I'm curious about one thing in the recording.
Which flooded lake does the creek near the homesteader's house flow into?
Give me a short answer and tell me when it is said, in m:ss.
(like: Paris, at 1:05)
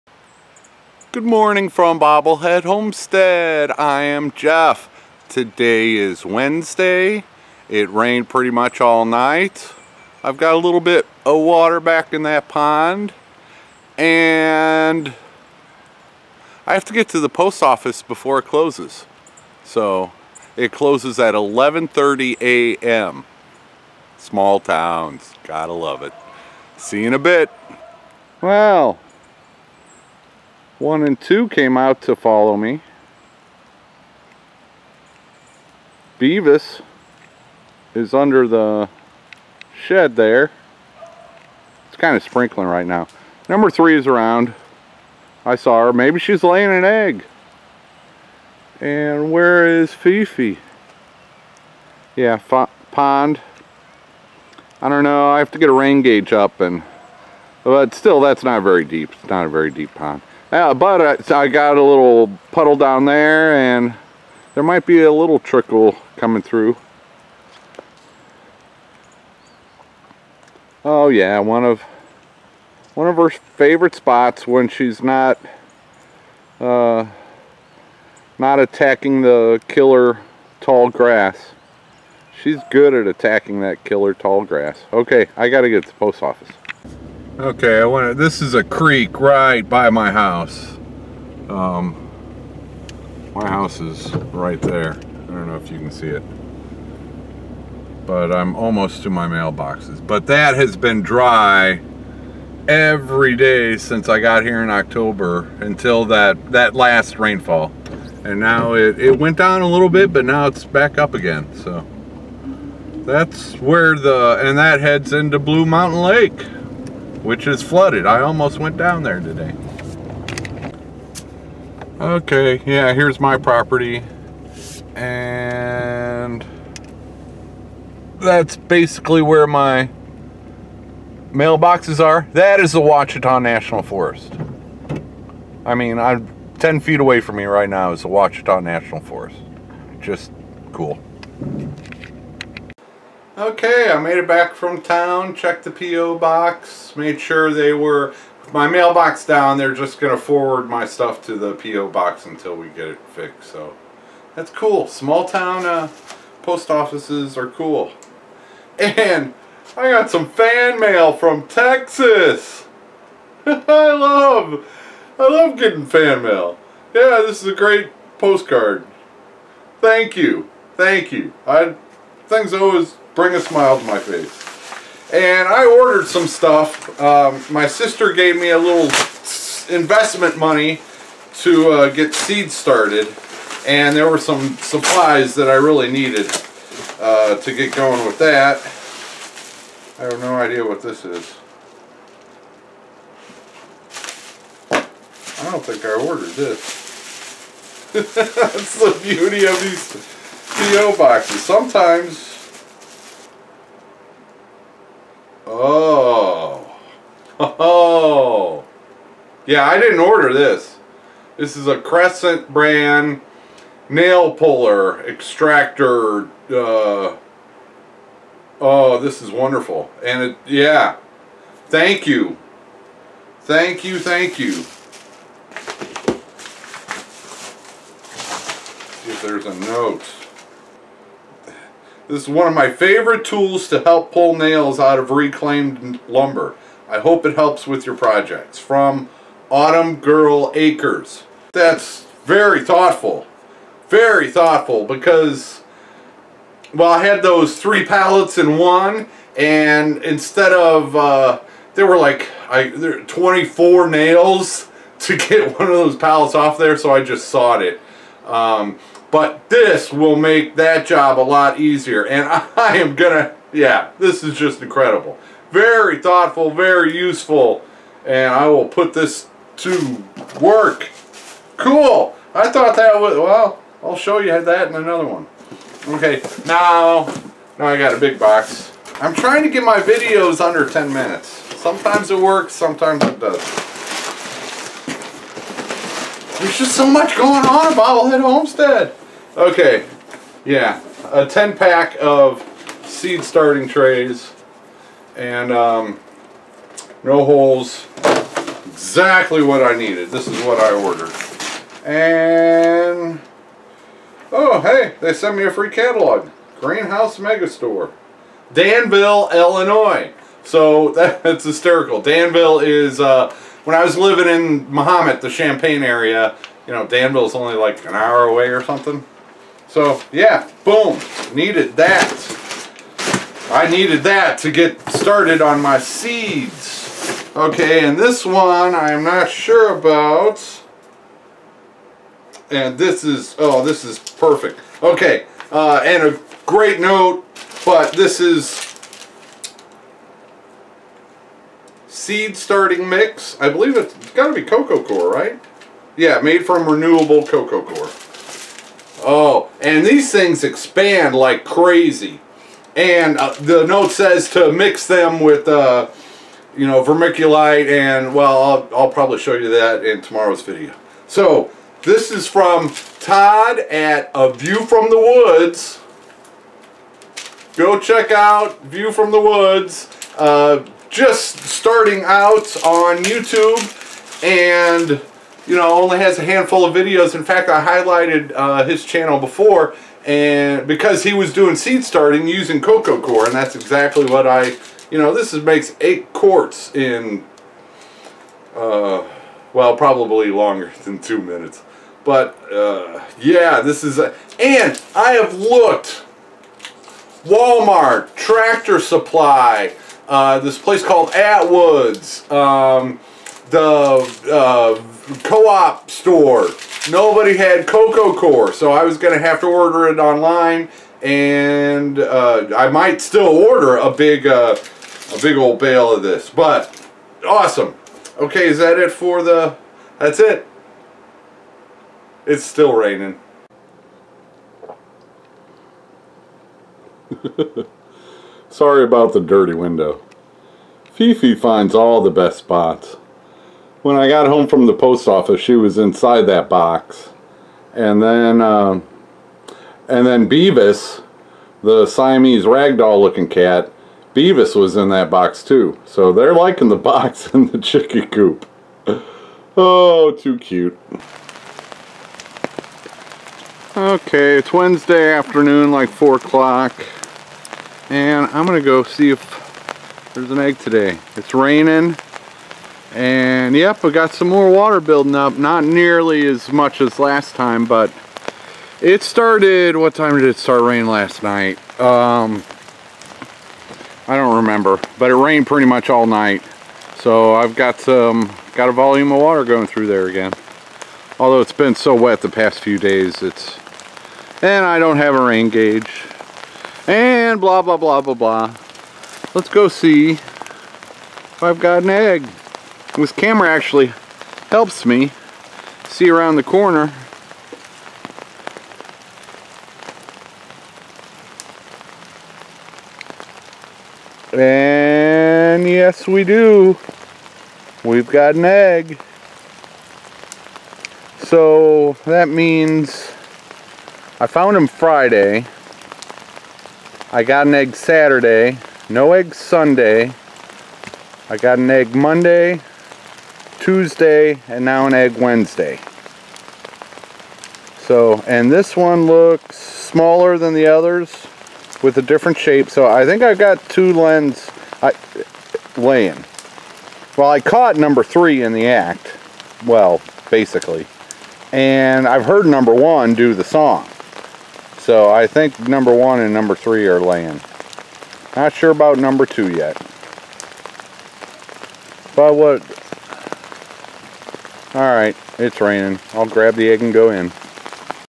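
Blue Mountain Lake, at 1:55.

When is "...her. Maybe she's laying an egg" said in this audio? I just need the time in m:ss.
0:45.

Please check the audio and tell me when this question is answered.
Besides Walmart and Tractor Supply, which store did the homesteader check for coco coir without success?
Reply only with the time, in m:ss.
6:41.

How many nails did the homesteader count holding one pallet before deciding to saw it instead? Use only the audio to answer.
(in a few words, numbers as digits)
24.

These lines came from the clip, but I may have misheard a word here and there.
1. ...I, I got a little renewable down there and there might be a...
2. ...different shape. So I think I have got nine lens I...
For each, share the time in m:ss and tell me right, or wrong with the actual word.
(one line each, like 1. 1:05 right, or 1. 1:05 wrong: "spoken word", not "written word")
1. 1:01 wrong: "puddle", not "renewable"
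2. 8:52 wrong: "two", not "nine".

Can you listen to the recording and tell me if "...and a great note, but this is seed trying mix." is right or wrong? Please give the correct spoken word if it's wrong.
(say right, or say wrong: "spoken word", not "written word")
wrong: "starting", not "trying".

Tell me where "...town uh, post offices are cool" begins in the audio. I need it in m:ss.
2:35.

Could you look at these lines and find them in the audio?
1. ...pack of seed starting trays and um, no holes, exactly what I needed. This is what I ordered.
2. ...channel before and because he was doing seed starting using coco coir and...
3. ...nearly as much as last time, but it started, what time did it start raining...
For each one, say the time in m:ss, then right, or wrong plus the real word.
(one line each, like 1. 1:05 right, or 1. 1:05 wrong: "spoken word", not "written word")
1. 4:51 right
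2. 6:18 right
3. 7:45 right.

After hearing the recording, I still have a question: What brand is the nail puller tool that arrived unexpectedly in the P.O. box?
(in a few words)
Crescent.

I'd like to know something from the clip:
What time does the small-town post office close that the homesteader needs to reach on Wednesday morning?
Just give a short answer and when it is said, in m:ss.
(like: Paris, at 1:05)
11:30 a.m., at 0:21.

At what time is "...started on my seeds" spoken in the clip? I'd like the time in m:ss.
5:24.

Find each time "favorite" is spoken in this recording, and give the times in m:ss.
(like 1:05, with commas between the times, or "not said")
1:13, 3:52.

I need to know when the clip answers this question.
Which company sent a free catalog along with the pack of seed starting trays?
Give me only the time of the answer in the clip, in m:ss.
5:06.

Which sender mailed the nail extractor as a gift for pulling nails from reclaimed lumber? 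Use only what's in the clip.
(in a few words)
Autumn Girl Acres.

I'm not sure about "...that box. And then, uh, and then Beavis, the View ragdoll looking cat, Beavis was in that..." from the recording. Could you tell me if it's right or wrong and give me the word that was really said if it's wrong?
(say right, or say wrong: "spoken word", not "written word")
wrong: "Siamese", not "View".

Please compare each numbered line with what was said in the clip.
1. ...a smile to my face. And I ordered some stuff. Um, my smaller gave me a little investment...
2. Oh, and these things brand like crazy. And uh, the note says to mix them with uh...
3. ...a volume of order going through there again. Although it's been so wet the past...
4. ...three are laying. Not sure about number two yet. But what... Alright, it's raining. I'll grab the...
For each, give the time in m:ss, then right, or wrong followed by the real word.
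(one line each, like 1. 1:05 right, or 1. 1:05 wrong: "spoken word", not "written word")
1. 2:53 wrong: "sister", not "smaller"
2. 5:49 wrong: "expand", not "brand"
3. 7:58 wrong: "water", not "order"
4. 9:06 right.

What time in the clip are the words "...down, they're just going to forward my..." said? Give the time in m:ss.
2:29.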